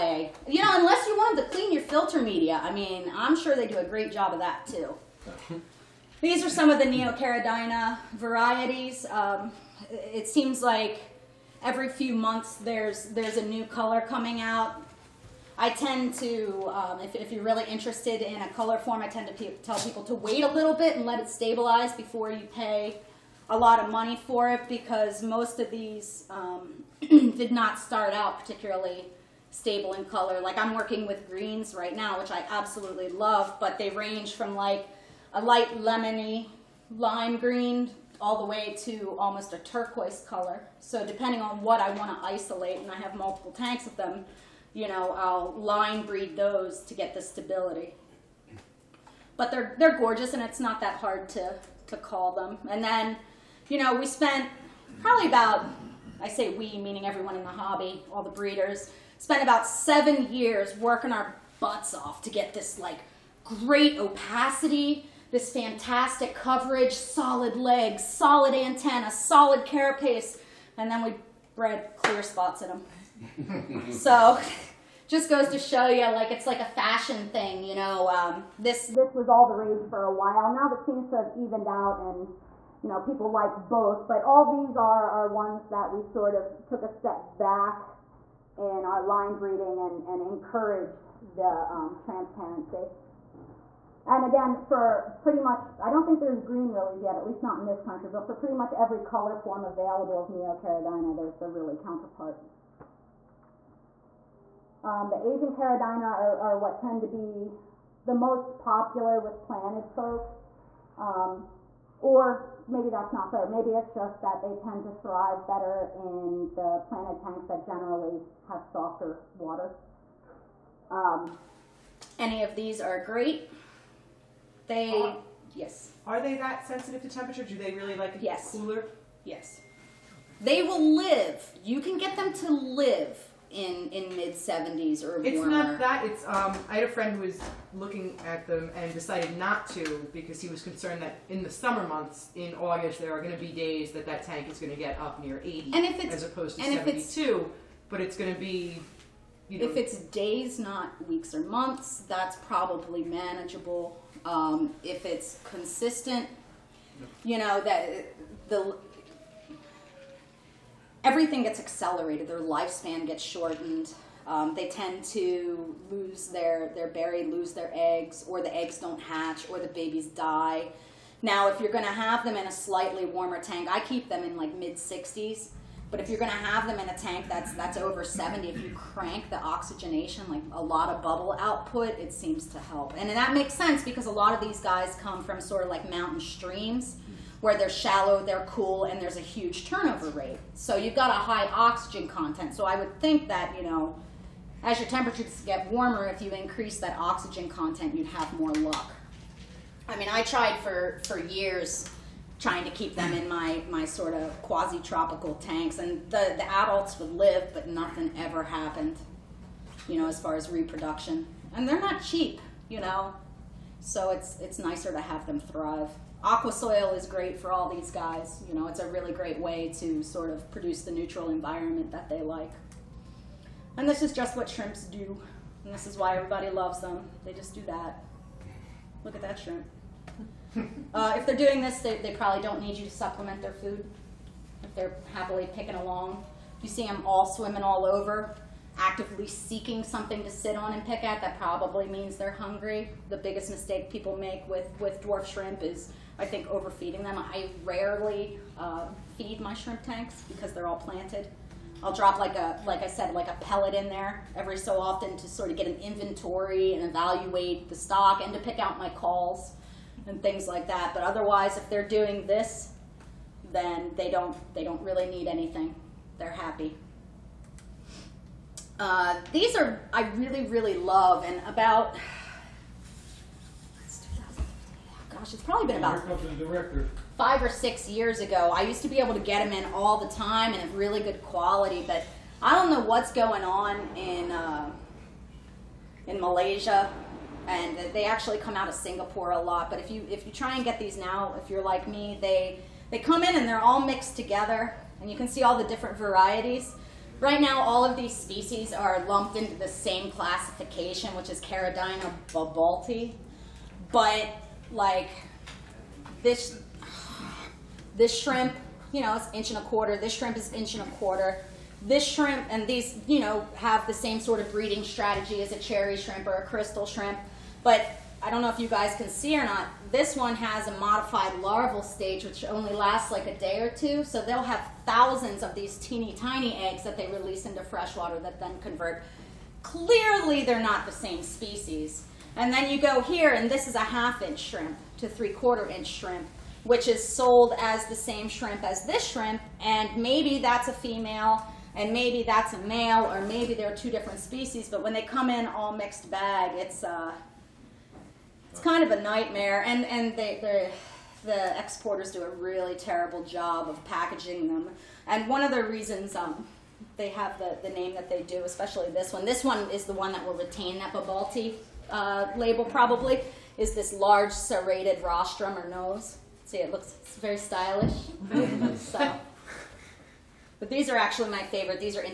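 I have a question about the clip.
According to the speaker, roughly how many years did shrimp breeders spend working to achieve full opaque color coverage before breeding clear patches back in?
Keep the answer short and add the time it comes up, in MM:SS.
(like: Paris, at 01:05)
7 years, at 00:59.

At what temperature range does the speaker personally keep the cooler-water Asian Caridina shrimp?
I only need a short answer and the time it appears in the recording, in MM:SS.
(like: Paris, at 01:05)
mid 60s, at 02:54.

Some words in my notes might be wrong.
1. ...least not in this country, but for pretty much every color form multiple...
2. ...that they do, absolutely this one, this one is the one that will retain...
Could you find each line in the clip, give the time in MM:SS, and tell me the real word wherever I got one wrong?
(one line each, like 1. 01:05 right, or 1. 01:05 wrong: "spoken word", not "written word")
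1. 01:37 wrong: "available", not "multiple"
2. 05:57 wrong: "especially", not "absolutely".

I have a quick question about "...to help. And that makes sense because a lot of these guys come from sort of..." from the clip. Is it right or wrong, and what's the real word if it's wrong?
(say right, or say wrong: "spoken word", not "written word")
right.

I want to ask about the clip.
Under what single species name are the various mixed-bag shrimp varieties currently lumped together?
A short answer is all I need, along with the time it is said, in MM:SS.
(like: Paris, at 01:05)
Caridina babaulti, at 05:01.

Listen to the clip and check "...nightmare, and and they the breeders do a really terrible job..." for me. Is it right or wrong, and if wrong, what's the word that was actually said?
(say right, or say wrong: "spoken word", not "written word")
wrong: "exporters", not "breeders".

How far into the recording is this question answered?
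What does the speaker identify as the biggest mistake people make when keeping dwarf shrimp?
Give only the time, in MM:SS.
04:06.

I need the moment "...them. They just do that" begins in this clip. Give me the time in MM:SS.
03:46.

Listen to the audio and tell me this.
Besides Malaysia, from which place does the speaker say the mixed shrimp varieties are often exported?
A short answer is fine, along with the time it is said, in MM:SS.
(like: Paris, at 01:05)
Singapore, at 04:48.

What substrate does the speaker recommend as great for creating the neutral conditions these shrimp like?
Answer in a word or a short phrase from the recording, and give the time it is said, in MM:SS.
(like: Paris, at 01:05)
Aqua soil, at 03:36.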